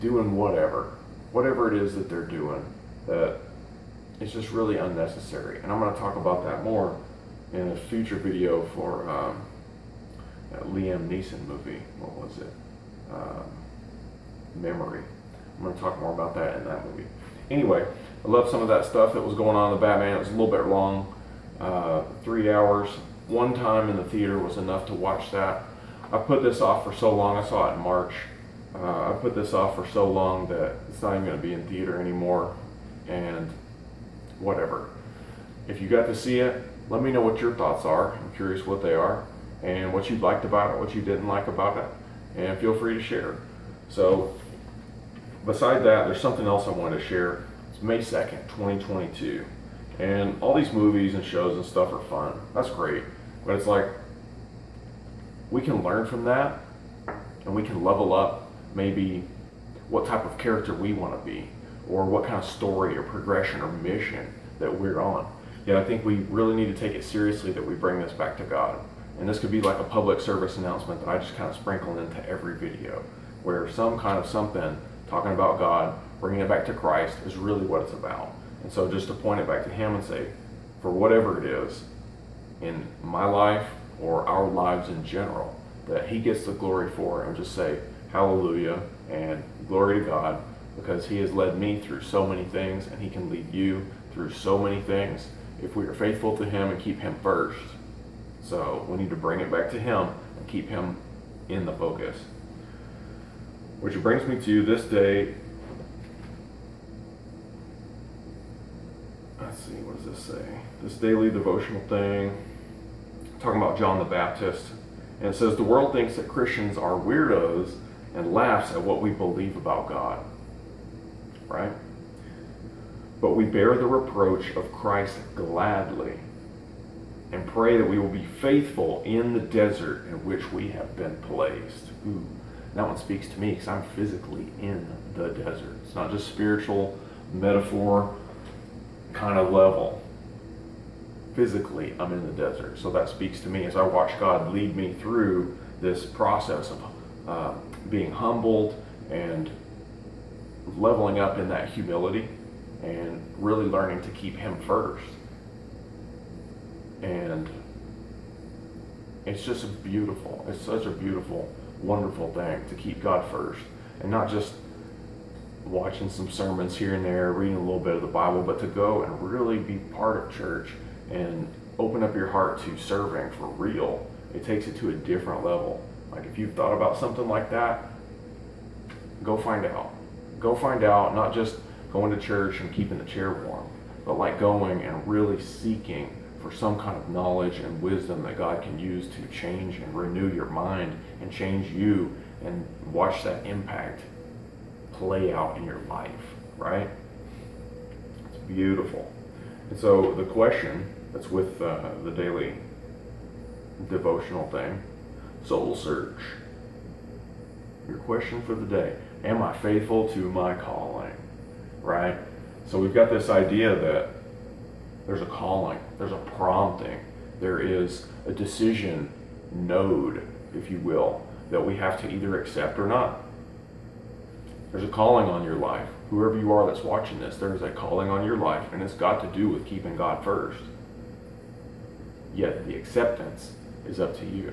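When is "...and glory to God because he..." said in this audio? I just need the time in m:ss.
1:29.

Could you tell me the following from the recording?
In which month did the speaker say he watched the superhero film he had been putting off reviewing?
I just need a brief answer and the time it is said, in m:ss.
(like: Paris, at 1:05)
March, at 0:27.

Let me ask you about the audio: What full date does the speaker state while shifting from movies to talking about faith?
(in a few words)
May 2, 2022.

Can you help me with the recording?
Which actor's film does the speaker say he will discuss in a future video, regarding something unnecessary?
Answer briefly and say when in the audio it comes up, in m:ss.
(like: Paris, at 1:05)
Liam Neeson, at 0:10.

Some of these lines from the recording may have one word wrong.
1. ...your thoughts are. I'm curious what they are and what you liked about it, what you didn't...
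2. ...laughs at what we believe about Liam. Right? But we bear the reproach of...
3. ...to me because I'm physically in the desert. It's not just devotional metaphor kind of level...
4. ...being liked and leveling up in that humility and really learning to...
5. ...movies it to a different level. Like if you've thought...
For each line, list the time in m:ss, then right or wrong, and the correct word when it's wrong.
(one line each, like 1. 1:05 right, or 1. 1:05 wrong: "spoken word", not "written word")
1. 0:37 right
2. 1:58 wrong: "God", not "Liam"
3. 2:13 wrong: "spiritual", not "devotional"
4. 2:27 wrong: "humbled", not "liked"
5. 2:54 wrong: "takes", not "movies".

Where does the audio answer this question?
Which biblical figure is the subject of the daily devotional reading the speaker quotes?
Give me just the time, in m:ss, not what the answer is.
1:53.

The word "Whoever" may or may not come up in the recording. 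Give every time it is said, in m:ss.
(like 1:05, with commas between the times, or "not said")
3:46.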